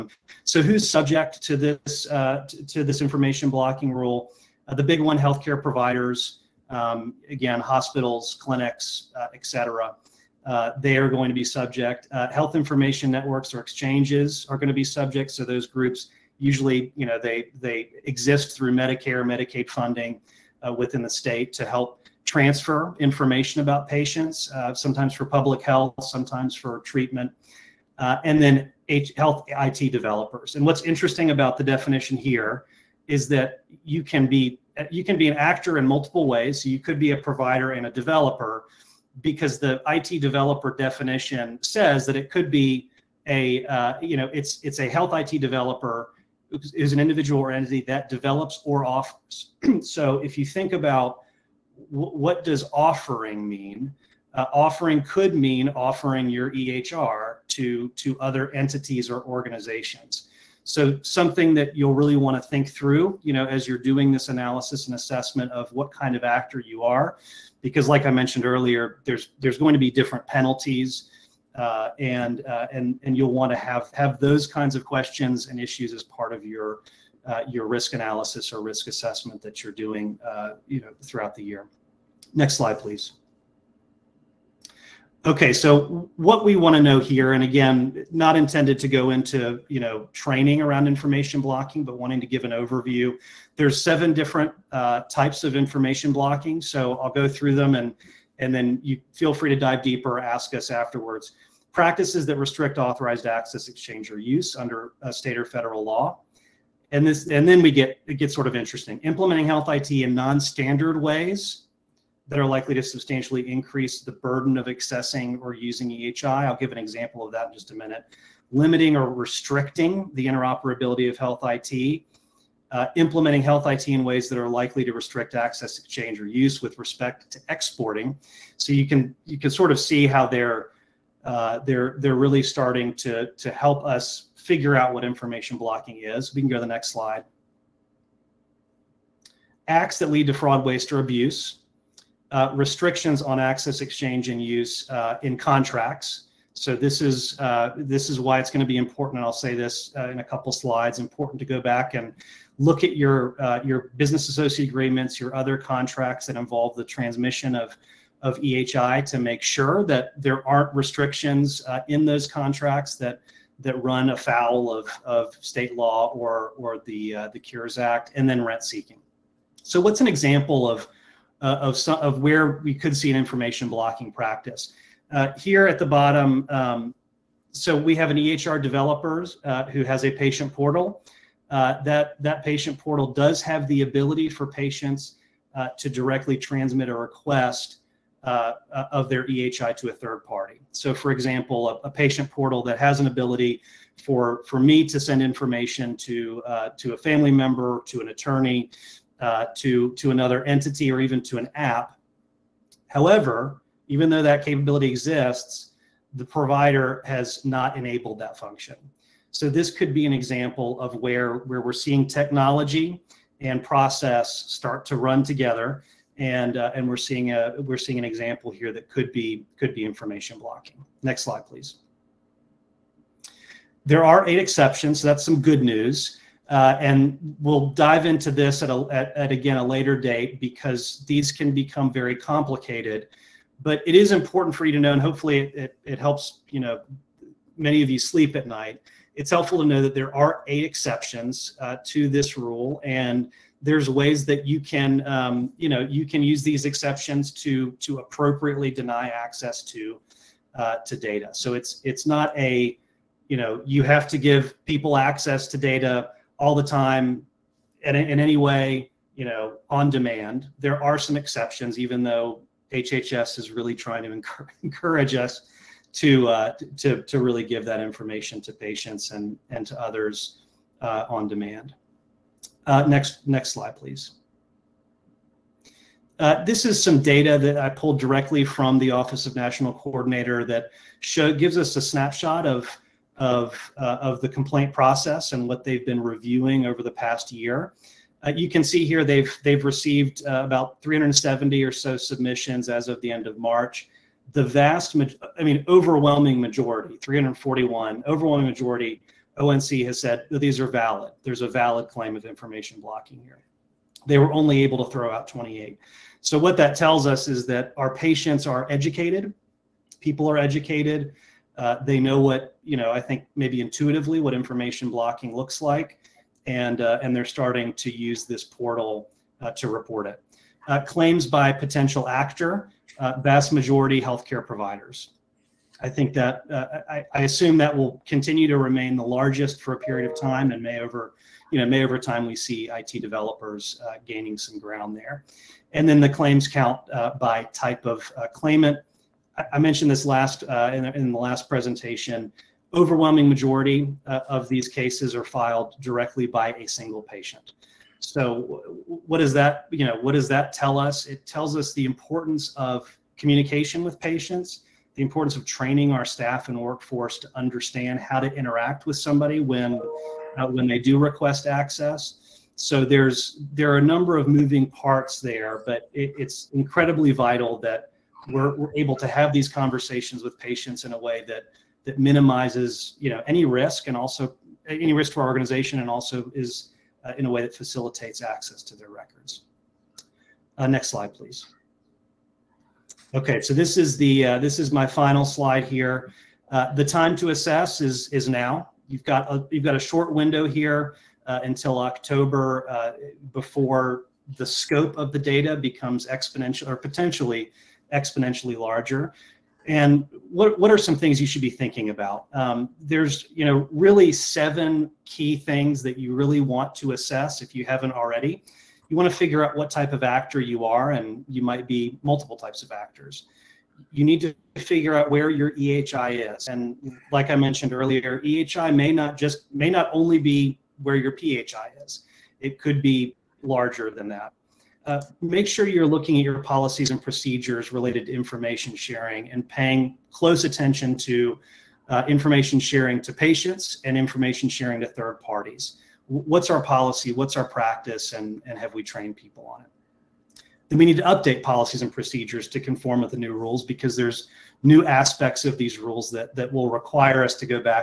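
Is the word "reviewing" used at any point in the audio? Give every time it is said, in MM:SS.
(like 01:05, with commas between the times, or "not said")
04:46.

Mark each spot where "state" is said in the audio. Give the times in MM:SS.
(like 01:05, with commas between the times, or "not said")
00:21, 01:45, 02:45.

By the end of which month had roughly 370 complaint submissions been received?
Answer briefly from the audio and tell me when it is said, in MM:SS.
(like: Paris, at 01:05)
March, at 04:53.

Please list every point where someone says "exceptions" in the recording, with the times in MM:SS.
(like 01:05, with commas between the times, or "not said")
03:44, 04:00, 04:06, 04:21.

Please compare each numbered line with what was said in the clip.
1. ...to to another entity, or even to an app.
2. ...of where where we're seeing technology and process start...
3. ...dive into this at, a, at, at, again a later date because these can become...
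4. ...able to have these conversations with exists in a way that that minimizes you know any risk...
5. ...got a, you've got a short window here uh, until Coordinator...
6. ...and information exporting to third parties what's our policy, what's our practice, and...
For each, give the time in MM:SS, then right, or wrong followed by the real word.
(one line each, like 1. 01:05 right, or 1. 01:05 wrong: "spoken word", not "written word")
1. 03:19 right
2. 03:30 right
3. 03:47 right
4. 06:08 wrong: "patients", not "exists"
5. 06:29 wrong: "October", not "Coordinator"
6. 07:13 wrong: "sharing", not "exporting".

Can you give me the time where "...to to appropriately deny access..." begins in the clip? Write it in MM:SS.
04:07.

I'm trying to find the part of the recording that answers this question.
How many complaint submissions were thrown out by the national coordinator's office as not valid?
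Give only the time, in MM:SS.
05:05.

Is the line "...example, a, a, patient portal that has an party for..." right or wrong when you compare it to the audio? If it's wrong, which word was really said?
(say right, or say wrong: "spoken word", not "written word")
wrong: "ability", not "party".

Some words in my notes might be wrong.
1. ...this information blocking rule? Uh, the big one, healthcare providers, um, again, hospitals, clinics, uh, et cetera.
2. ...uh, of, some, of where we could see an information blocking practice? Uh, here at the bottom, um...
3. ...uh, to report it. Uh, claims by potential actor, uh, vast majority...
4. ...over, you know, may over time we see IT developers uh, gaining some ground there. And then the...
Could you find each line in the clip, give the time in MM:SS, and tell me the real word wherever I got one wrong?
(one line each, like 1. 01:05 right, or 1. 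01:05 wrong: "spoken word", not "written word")
1. 00:02 right
2. 02:51 right
3. 05:19 right
4. 05:30 right.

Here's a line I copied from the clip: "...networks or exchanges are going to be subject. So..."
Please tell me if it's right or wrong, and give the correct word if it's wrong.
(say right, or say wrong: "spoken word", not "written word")
right.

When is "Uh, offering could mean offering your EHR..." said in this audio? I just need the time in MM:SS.
00:54.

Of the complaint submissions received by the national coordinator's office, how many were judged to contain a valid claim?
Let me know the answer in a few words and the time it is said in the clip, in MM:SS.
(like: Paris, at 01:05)
341, at 04:56.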